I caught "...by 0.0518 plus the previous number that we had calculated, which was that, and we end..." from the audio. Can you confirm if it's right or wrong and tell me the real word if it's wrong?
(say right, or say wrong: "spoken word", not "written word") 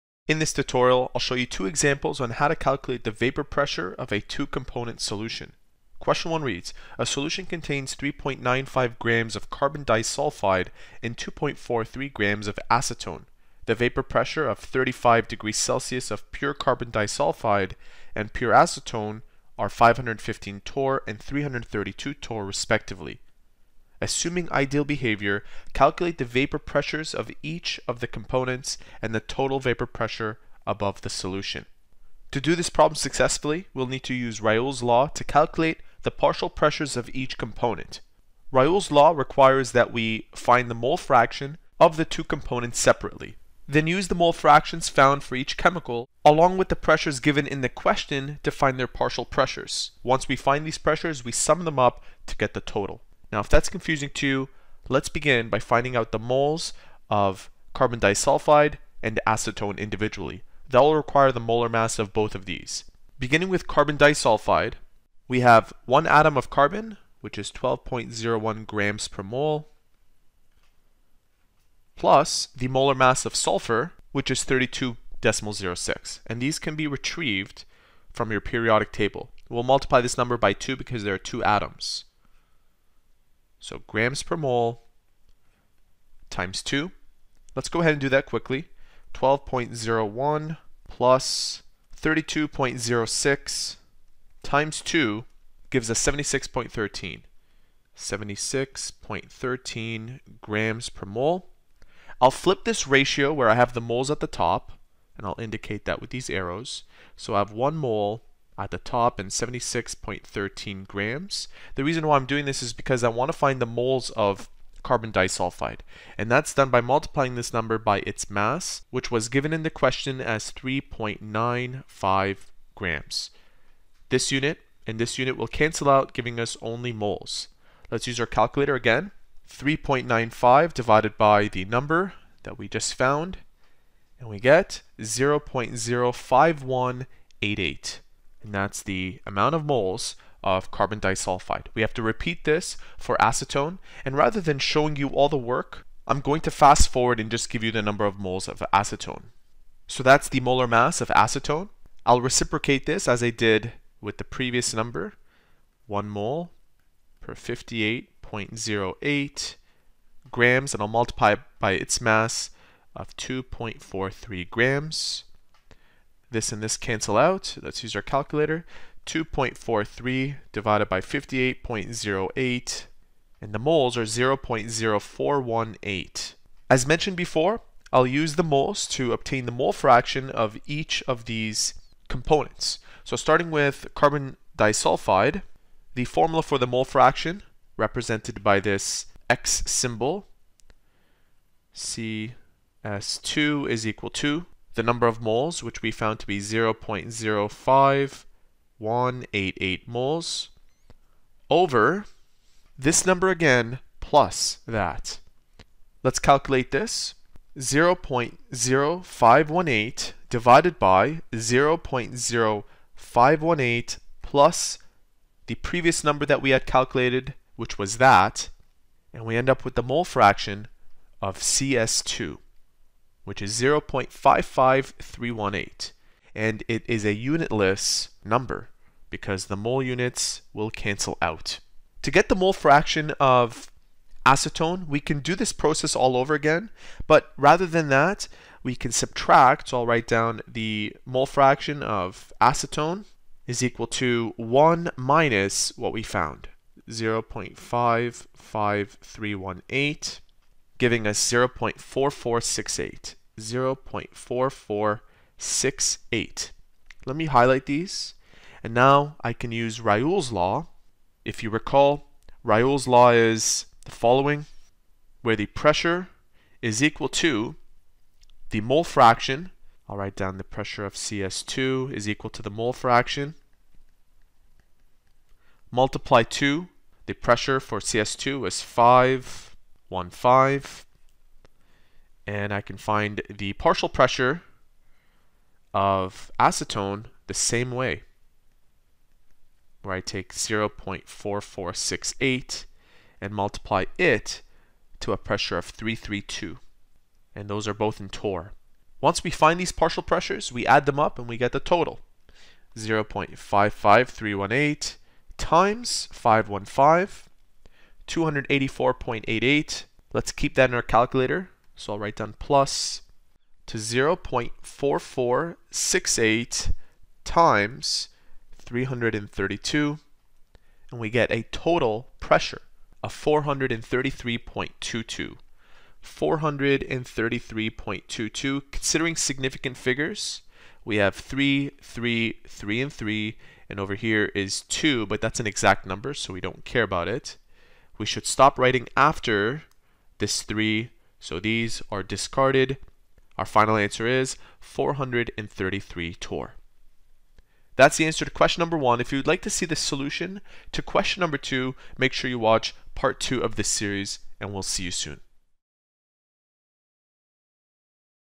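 right.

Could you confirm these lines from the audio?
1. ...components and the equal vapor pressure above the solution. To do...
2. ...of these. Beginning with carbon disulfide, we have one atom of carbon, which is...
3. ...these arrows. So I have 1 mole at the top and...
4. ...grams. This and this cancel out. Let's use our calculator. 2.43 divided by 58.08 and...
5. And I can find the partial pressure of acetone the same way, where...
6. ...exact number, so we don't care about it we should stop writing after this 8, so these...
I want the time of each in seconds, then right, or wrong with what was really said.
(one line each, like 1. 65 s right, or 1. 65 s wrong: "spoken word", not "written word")
1. 28 s wrong: "total", not "equal"
2. 62 s right
3. 106 s right
4. 164 s right
5. 282 s right
6. 335 s wrong: "3", not "8".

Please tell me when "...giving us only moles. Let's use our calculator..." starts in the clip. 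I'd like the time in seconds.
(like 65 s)
126 s.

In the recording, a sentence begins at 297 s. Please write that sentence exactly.
And those are both in torr.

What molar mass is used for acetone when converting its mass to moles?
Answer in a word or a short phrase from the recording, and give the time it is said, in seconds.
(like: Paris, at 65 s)
58.08 grams, at 157 s.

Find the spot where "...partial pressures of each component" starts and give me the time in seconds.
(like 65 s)
36 s.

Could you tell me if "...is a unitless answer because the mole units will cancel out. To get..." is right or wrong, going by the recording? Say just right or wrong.
wrong.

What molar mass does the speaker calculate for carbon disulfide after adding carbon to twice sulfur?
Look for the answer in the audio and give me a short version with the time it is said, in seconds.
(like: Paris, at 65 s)
76.13 grams per mole, at 97 s.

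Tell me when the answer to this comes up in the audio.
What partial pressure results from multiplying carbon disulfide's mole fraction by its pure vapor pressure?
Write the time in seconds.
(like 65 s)
308 s.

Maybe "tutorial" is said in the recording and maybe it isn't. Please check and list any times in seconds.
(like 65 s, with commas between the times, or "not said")
0 s.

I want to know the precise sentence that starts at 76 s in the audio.
And these can be retrieved from your periodic table.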